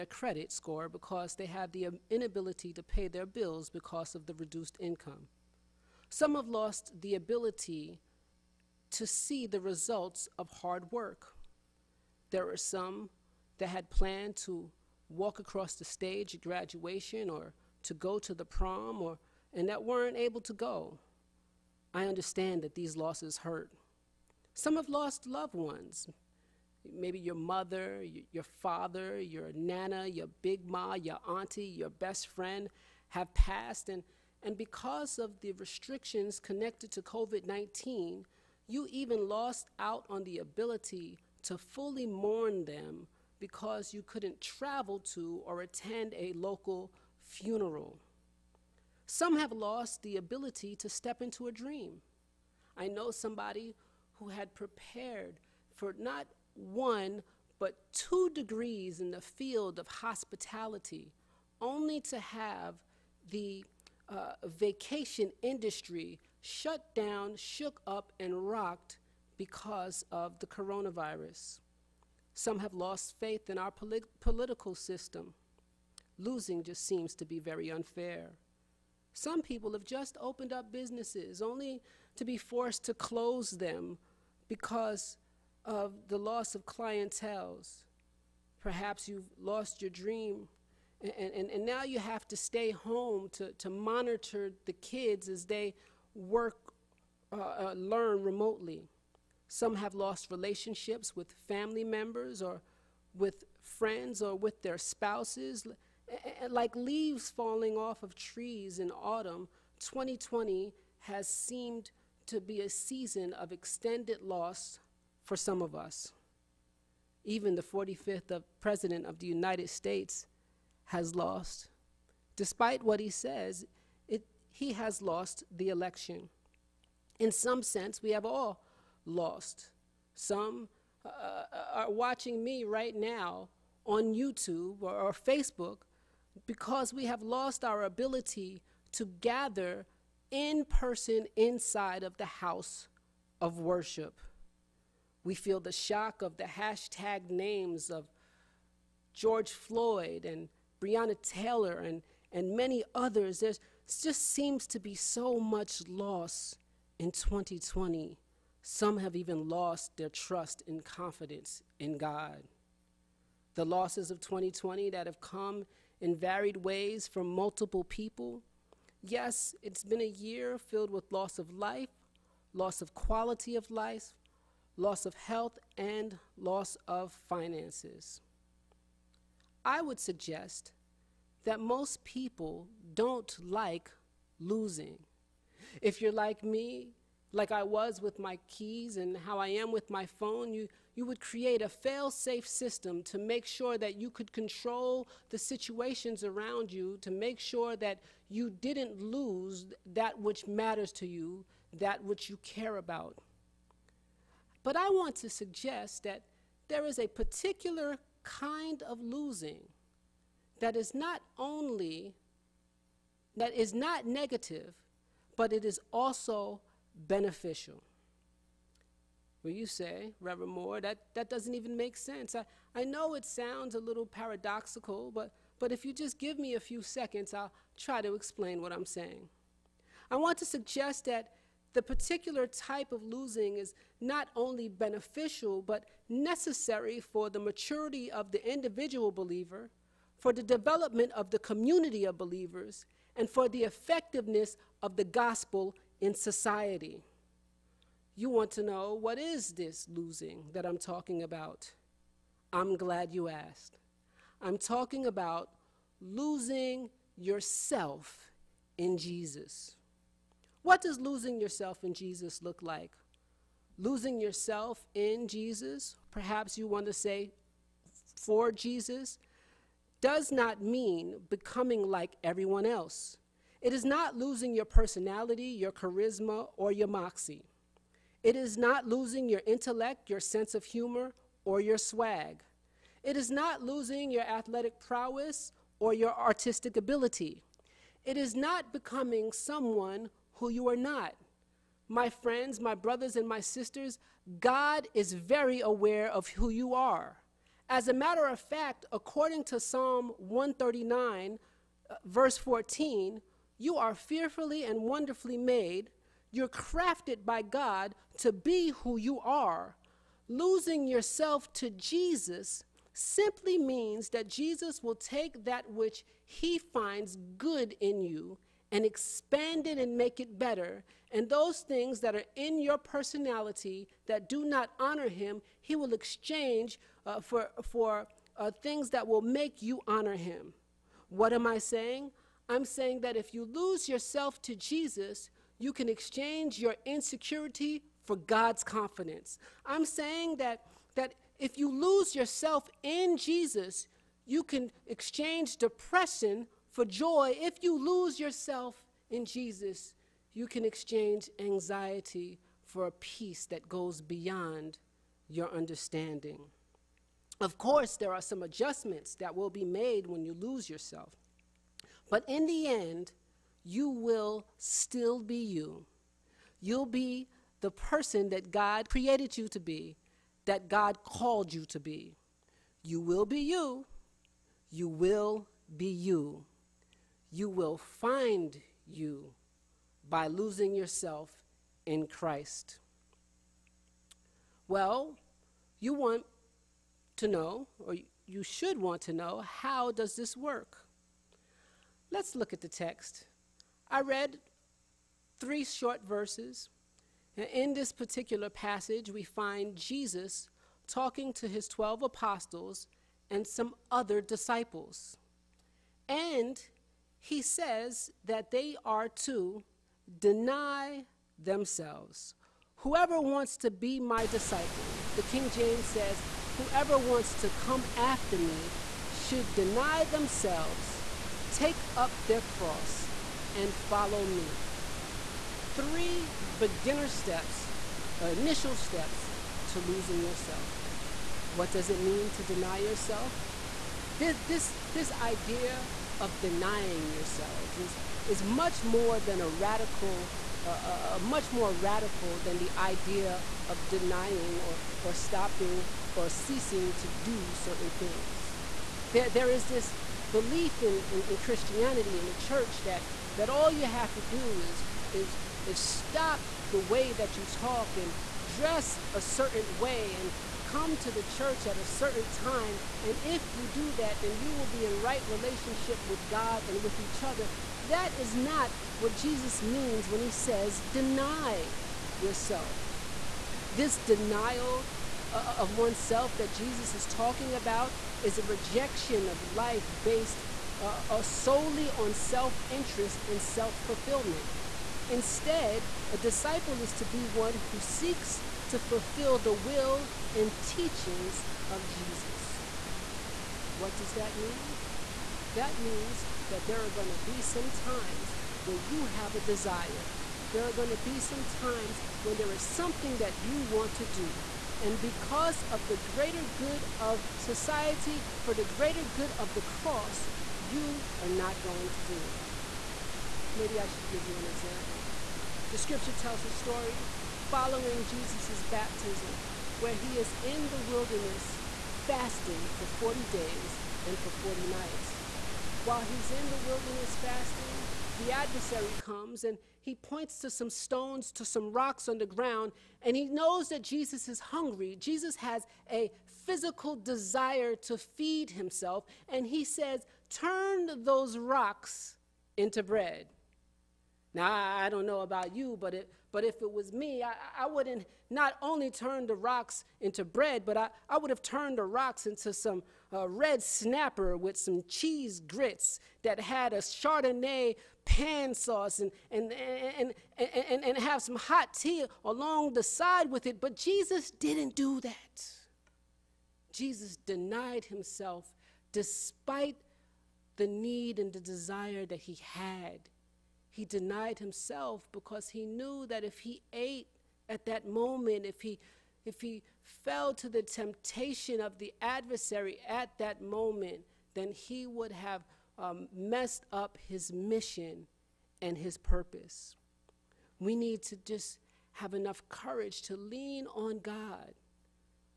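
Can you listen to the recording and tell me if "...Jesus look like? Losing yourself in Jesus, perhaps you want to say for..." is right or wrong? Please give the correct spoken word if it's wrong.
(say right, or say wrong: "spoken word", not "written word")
right.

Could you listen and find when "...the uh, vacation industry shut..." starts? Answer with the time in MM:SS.
01:03.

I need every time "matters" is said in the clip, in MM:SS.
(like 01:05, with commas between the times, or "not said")
03:20, 04:57.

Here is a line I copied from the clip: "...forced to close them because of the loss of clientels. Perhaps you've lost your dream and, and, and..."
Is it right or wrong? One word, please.
right.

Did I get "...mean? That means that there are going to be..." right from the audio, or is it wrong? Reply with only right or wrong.
right.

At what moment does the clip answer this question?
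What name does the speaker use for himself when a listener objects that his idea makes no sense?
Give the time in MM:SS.
03:40.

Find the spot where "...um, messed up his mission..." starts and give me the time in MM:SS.
09:45.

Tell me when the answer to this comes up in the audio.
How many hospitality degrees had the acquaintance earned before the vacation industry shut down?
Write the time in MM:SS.
00:57.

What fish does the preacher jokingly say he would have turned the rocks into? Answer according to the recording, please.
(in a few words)
red snapper.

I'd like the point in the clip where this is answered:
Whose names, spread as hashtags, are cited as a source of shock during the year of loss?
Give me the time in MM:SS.
02:29.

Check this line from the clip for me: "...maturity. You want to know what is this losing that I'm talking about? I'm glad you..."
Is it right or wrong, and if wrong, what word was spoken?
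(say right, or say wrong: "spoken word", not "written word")
wrong: "society", not "maturity".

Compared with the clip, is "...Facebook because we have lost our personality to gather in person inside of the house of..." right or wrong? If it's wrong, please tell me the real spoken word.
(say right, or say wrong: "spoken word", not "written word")
wrong: "ability", not "personality".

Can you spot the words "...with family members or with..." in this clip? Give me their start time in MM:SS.
01:41.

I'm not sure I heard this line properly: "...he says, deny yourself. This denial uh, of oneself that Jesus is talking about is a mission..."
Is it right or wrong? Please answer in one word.
wrong.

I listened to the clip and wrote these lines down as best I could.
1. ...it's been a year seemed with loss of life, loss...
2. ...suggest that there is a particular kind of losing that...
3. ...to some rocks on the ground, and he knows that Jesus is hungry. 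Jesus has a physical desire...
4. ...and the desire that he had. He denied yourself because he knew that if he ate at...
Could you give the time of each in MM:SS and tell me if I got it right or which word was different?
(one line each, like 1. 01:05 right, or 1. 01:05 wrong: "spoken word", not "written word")
1. 02:49 wrong: "filled", not "seemed"
2. 03:25 right
3. 08:51 right
4. 09:31 wrong: "himself", not "yourself".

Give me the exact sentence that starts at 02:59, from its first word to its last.
I would suggest that most people don't like losing.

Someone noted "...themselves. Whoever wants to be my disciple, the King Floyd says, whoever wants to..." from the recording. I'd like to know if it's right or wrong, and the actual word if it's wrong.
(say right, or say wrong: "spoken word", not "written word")
wrong: "James", not "Floyd".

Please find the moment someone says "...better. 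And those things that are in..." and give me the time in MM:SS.
05:20.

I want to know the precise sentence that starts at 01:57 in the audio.
Even the 45th of President of the United States has lost.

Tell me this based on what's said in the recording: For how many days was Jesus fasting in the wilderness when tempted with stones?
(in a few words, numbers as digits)
40.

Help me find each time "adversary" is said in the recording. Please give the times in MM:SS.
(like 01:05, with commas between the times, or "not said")
08:48, 09:42.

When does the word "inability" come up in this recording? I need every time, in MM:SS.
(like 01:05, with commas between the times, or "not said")
00:02.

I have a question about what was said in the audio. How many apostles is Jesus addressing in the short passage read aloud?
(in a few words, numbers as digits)
12.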